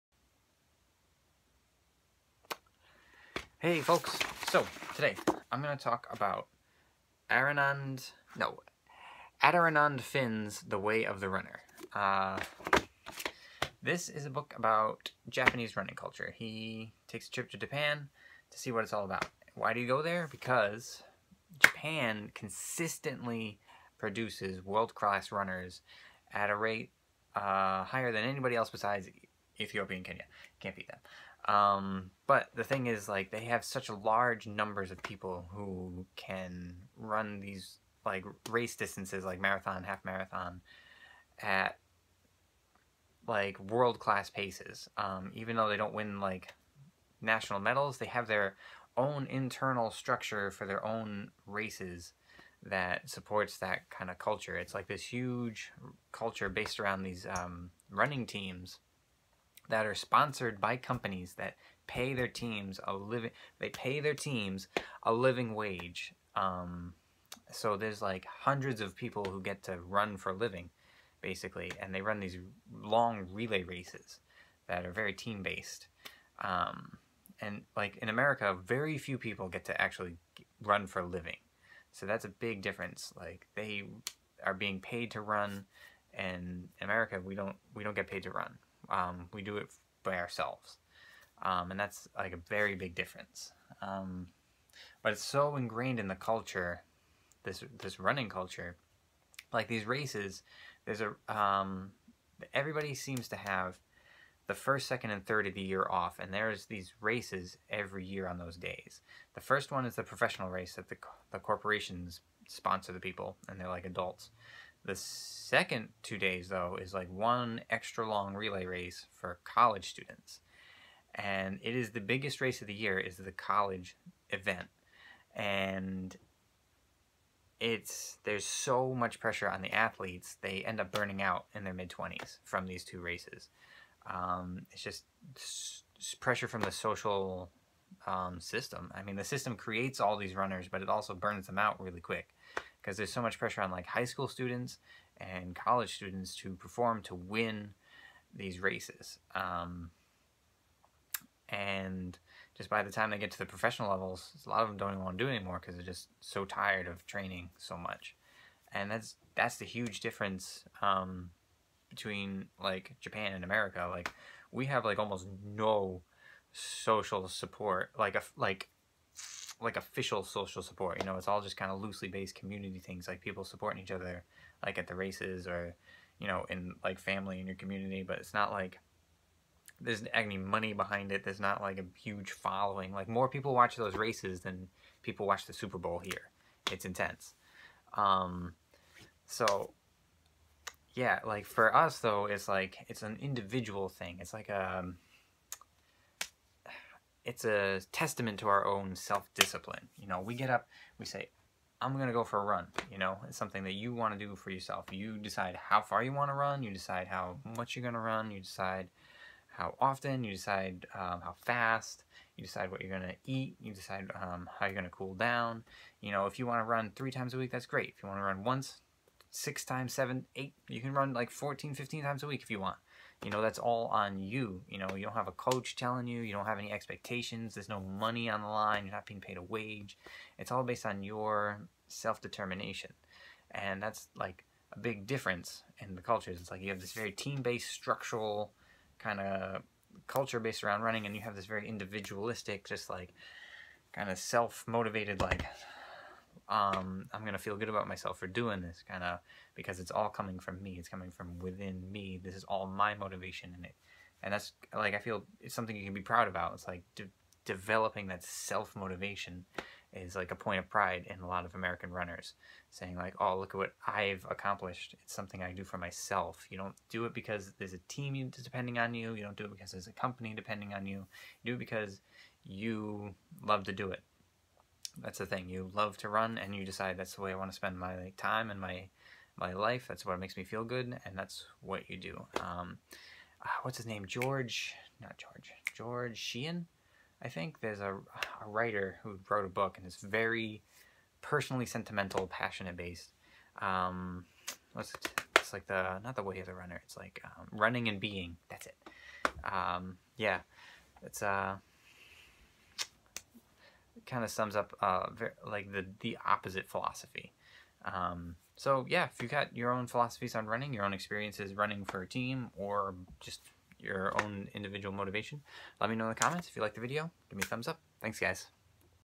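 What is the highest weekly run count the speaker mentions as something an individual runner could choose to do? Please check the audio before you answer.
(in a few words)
15.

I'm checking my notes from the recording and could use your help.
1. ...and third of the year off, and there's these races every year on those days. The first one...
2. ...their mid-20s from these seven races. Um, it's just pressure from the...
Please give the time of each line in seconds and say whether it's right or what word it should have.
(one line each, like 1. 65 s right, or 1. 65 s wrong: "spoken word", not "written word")
1. 105 s right
2. 131 s wrong: "two", not "seven".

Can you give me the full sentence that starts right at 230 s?
It's all based on your self-determination.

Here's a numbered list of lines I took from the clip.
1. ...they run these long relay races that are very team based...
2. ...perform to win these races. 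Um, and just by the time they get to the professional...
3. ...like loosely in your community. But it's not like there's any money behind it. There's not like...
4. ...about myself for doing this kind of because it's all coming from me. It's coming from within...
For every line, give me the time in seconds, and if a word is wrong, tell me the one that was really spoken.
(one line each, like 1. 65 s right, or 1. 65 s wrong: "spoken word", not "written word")
1. 71 s right
2. 146 s right
3. 176 s wrong: "family", not "loosely"
4. 247 s right.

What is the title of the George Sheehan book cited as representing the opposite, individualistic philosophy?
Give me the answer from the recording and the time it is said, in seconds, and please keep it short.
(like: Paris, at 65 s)
Running and Being, at 297 s.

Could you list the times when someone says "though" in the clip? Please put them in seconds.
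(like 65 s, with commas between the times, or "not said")
45 s, 116 s, 191 s.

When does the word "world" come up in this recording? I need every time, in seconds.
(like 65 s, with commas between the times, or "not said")
24 s, 43 s.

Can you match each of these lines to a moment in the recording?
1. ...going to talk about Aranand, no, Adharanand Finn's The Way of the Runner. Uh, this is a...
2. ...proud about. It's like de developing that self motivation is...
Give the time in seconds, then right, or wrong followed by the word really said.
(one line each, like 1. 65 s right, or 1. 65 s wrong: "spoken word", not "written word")
1. 5 s right
2. 256 s right.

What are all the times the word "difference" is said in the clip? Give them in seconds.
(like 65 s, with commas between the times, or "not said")
82 s, 92 s, 159 s, 235 s.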